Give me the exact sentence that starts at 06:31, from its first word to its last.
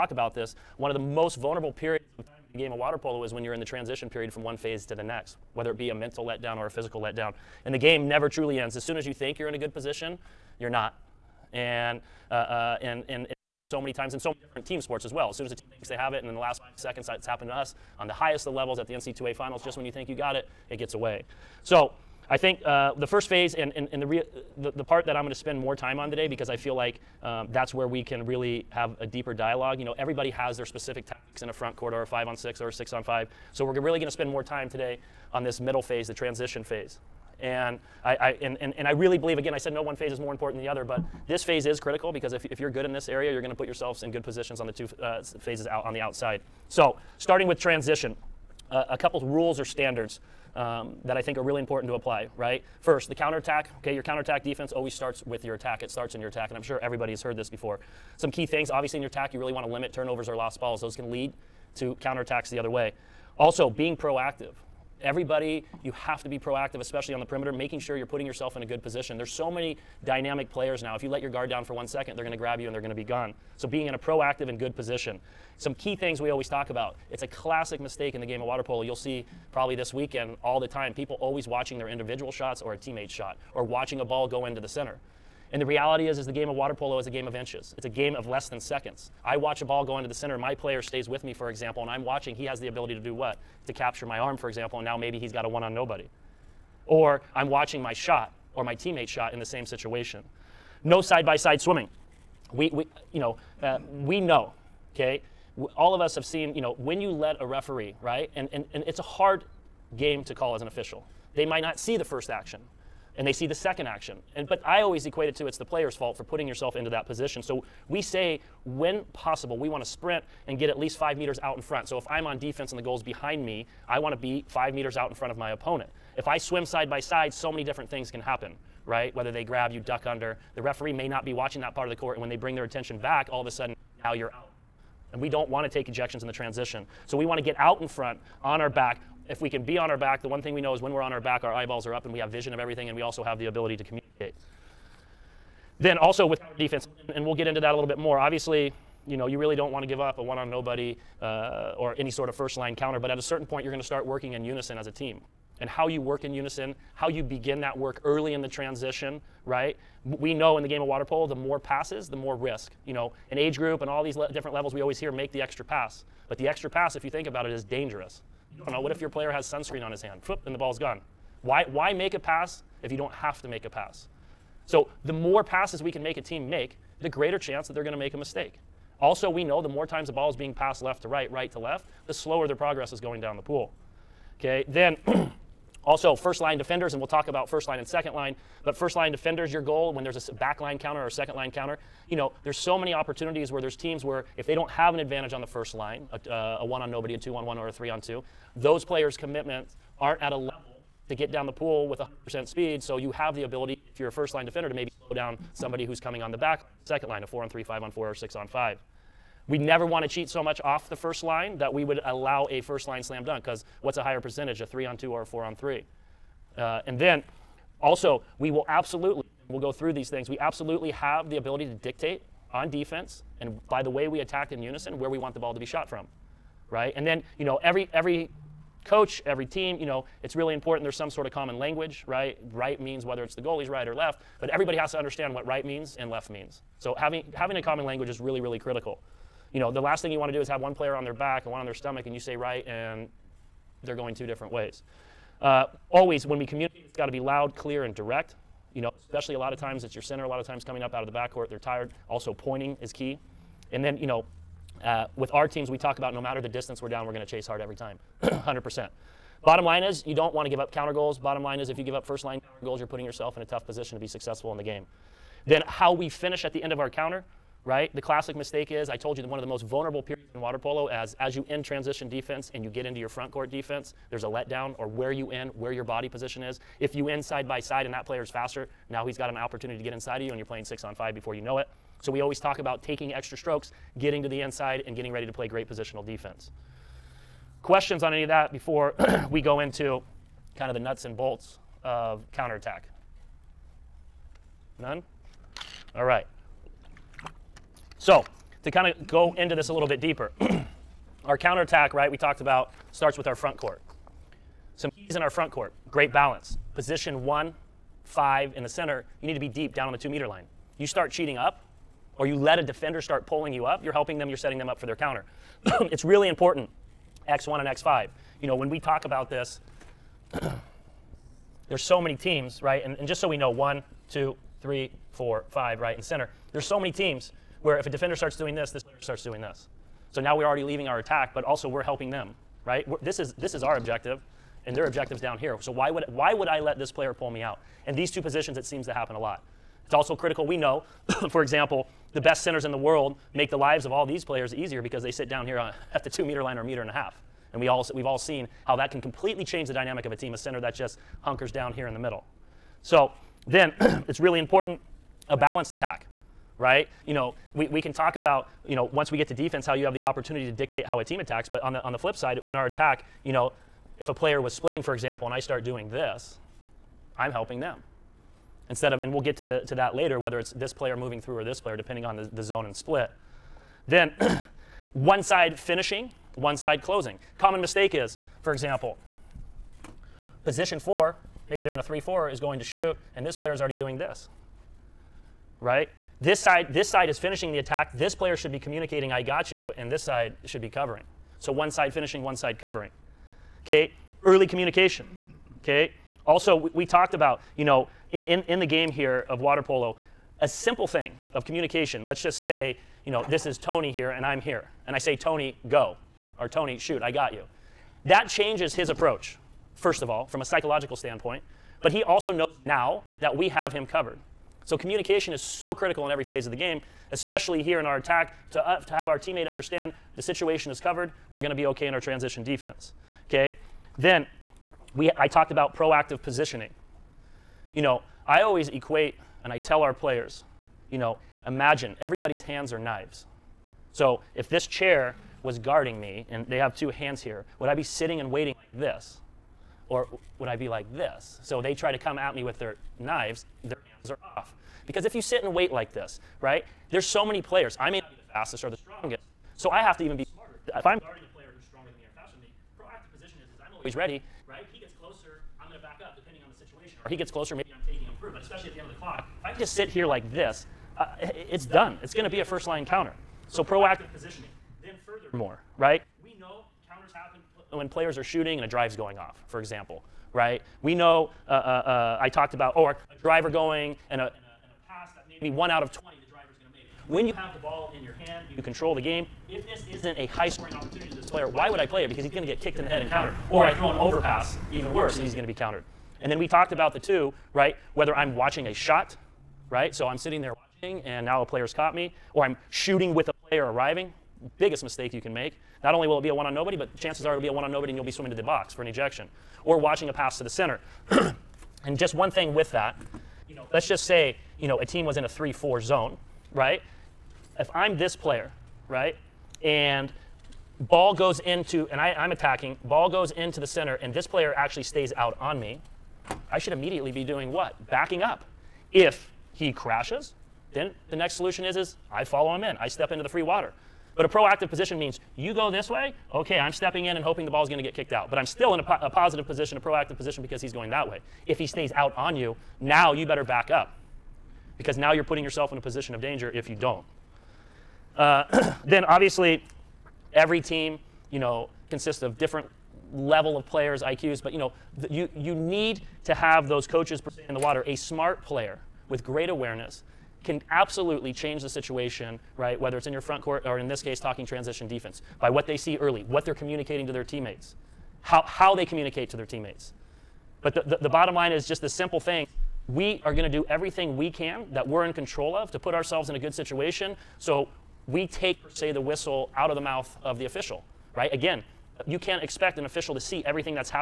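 So one side finishing, one side covering.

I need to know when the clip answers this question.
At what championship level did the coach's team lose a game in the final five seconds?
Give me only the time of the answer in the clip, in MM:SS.
00:18.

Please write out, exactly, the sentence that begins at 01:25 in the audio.
And the reality is, is the game of water polo is a game of inches.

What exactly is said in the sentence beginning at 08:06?
And then we talked about the two, right?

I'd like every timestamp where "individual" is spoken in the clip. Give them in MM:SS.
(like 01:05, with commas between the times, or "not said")
01:21.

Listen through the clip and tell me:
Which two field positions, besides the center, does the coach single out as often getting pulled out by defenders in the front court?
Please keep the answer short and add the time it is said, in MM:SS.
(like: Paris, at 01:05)
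X1 and X5, at 05:17.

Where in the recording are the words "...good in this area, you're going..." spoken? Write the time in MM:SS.
00:42.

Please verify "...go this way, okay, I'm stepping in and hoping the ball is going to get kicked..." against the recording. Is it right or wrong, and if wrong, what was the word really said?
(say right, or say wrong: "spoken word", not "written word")
right.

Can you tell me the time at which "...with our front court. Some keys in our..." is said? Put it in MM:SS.
05:03.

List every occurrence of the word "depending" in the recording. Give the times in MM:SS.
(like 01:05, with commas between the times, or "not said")
06:11, 07:36.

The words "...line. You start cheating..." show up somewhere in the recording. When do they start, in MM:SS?
05:10.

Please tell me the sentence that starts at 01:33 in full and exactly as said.
To capture my arm, for example, and now maybe he's got a one on nobody.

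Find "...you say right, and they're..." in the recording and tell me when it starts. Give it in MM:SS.
04:02.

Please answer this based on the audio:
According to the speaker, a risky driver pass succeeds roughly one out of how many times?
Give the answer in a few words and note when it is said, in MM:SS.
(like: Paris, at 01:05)
20, at 07:55.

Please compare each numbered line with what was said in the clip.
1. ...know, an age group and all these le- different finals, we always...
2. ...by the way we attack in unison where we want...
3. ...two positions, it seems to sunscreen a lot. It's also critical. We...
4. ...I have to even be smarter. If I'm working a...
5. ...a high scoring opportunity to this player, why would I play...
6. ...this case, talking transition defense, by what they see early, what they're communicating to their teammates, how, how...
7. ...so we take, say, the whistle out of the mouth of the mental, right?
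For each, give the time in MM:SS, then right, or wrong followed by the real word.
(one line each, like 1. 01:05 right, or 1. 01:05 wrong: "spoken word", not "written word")
1. 02:42 wrong: "levels", not "finals"
2. 03:43 right
3. 05:38 wrong: "happen", not "sunscreen"
4. 07:29 wrong: "guarding", not "working"
5. 08:00 right
6. 09:13 right
7. 09:27 wrong: "official", not "mental".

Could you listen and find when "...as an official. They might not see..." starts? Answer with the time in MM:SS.
01:50.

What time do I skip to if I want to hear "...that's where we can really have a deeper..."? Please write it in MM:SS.
00:27.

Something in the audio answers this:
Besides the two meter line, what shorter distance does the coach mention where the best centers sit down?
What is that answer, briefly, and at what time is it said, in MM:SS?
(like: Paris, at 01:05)
meter and a half, at 05:46.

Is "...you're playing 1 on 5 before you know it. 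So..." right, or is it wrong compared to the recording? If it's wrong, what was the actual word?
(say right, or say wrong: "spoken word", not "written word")
wrong: "6", not "1".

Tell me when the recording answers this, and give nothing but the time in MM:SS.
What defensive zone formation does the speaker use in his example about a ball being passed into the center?
08:25.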